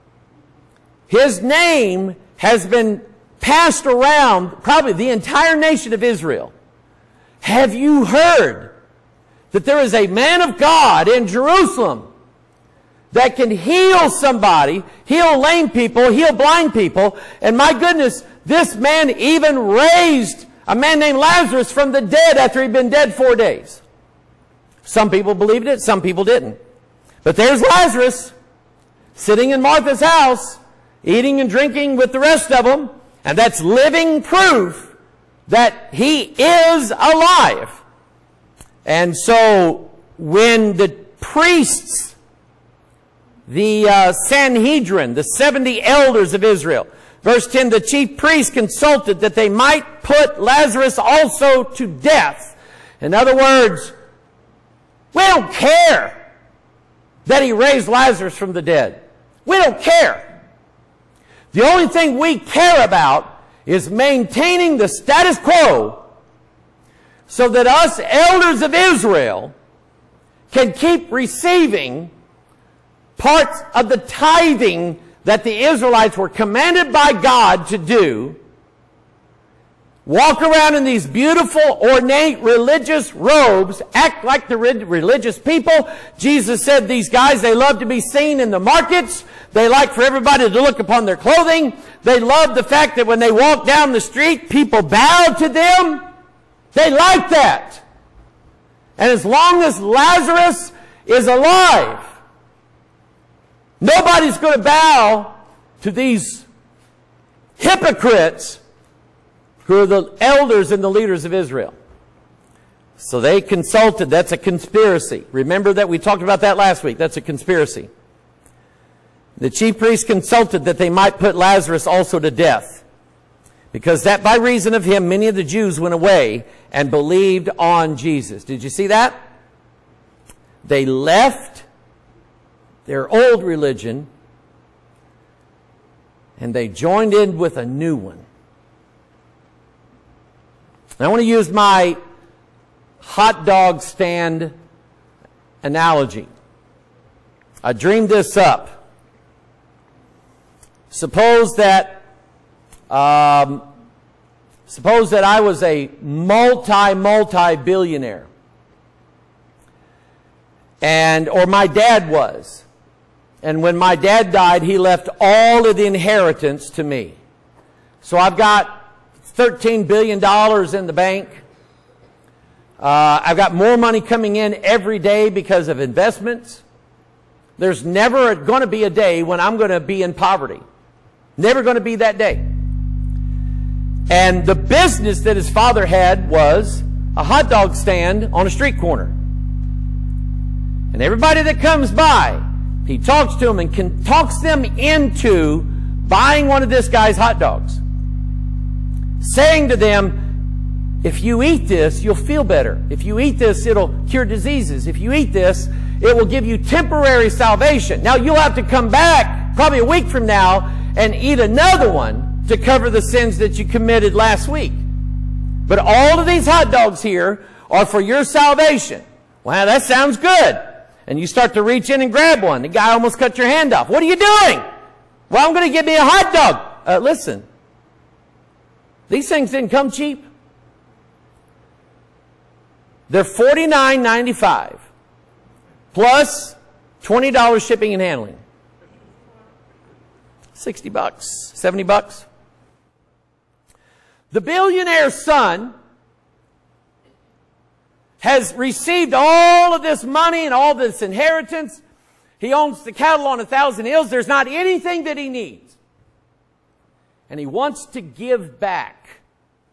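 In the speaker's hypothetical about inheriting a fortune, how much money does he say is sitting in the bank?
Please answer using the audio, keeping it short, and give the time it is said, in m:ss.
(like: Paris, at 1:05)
$13 billion, at 2:49.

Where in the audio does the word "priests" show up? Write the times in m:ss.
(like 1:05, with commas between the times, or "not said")
0:41, 0:48, 1:59.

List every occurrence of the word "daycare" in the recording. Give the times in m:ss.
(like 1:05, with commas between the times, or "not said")
not said.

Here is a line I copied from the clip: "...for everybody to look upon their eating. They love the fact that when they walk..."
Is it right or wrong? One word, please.
wrong.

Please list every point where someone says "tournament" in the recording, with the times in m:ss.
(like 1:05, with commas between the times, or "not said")
not said.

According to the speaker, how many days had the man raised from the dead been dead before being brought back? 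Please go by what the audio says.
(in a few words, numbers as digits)
4.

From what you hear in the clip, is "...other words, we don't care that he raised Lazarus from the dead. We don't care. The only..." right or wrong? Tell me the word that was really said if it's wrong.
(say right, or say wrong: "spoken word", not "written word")
right.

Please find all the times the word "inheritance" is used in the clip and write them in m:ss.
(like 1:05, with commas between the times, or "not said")
2:45, 4:11.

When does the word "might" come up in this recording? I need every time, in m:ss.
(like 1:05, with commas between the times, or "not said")
0:49, 2:00.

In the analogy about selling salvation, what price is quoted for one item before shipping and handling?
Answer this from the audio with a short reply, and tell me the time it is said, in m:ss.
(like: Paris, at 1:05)
$49.95, at 3:53.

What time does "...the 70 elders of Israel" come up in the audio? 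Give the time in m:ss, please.
0:45.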